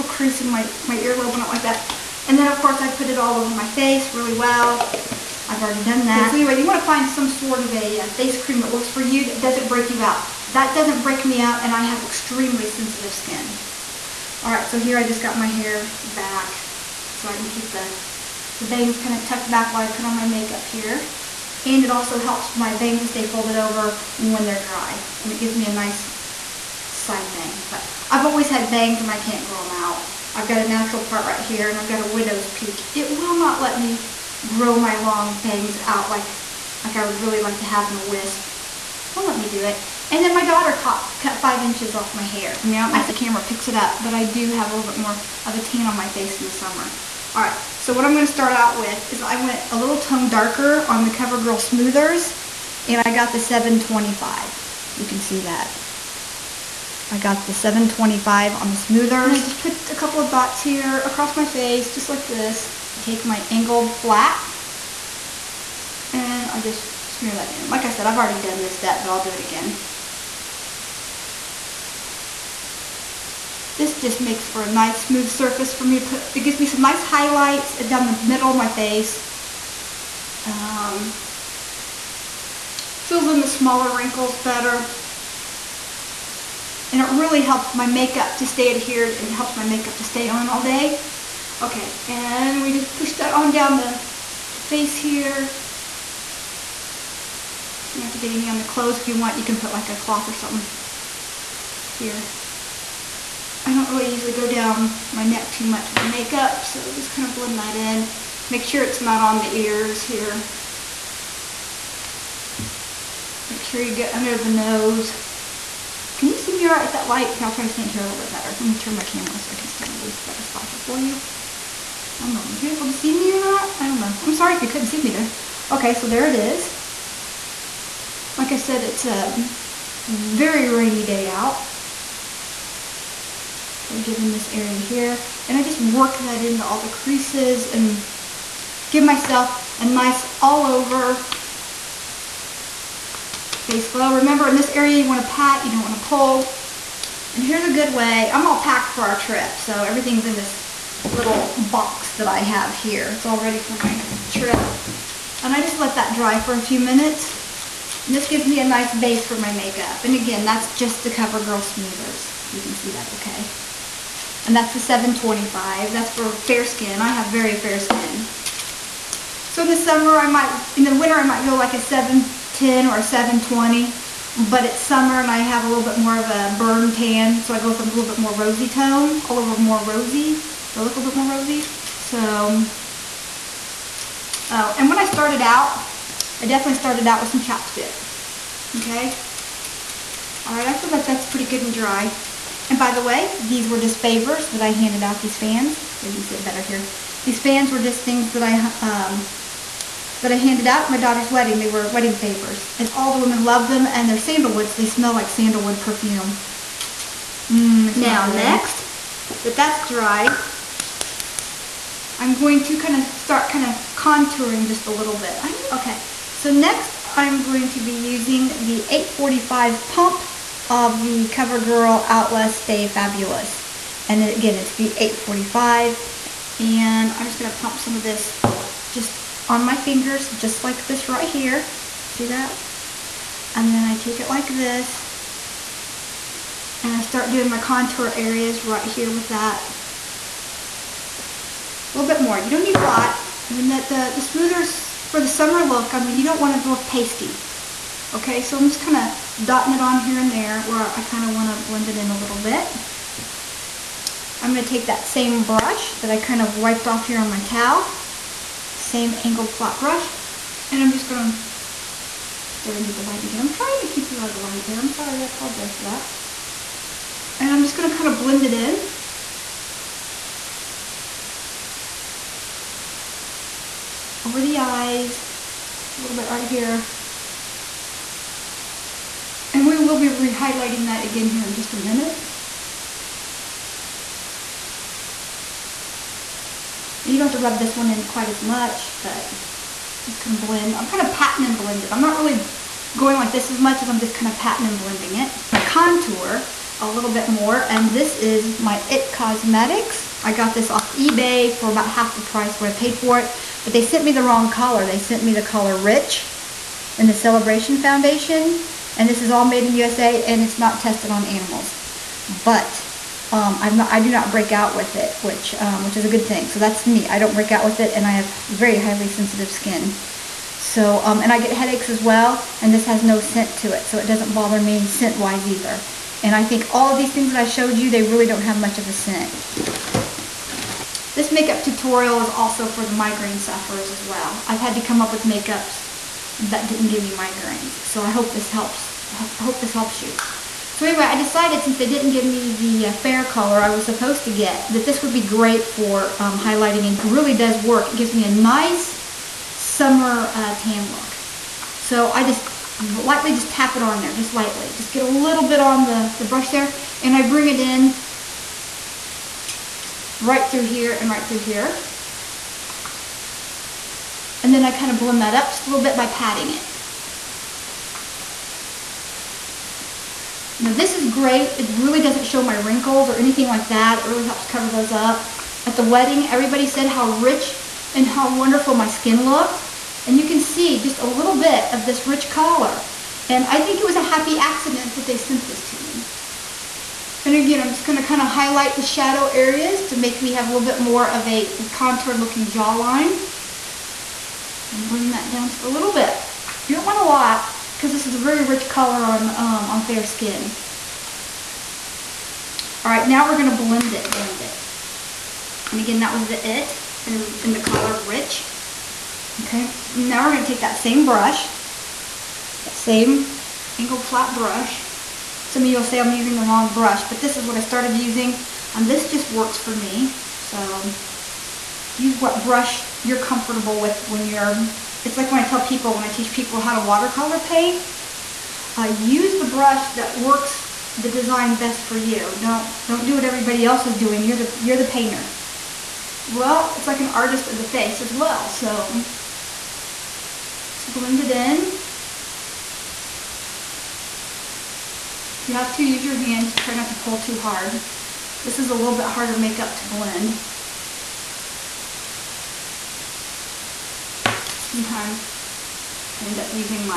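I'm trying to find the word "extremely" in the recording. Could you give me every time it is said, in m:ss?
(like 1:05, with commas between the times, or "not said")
0:12.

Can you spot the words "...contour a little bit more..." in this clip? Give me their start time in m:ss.
4:55.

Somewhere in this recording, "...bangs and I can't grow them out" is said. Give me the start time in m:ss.
0:28.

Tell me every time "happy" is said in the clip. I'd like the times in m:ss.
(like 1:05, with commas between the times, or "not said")
6:24.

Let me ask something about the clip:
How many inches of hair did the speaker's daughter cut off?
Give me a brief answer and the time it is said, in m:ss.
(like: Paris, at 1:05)
5, at 0:41.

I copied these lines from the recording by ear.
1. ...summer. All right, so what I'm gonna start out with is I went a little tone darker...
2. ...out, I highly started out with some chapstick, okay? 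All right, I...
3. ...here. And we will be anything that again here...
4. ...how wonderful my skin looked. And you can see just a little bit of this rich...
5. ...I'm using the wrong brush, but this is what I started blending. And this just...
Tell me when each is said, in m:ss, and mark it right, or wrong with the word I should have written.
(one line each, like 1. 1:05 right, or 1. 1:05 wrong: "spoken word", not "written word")
1. 0:46 right
2. 3:05 wrong: "definitely", not "highly"
3. 4:36 wrong: "rehighlighting", not "anything"
4. 6:18 right
5. 6:55 wrong: "using", not "blending".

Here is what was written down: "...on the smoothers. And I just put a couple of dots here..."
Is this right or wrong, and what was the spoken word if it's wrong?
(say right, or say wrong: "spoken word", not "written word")
right.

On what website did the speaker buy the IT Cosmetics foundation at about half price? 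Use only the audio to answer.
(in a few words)
eBay.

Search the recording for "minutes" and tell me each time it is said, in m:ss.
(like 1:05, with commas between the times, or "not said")
2:36, 4:41.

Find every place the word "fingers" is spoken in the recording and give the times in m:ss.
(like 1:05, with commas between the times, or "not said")
3:49.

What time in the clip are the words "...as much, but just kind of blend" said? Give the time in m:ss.
4:48.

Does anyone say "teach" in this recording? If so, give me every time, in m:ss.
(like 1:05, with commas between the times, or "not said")
7:06.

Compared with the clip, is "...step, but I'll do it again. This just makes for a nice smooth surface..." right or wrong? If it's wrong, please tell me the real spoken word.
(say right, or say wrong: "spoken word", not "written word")
right.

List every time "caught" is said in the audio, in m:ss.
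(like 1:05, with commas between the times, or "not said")
0:40.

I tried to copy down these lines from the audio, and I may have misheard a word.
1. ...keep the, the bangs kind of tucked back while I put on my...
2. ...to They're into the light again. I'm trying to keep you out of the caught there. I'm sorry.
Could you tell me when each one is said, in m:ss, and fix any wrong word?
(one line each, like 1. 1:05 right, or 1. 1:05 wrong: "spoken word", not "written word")
1. 0:17 right
2. 4:21 wrong: "light", not "caught".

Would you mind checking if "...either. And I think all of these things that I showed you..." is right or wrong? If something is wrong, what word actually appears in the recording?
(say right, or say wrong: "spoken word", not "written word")
right.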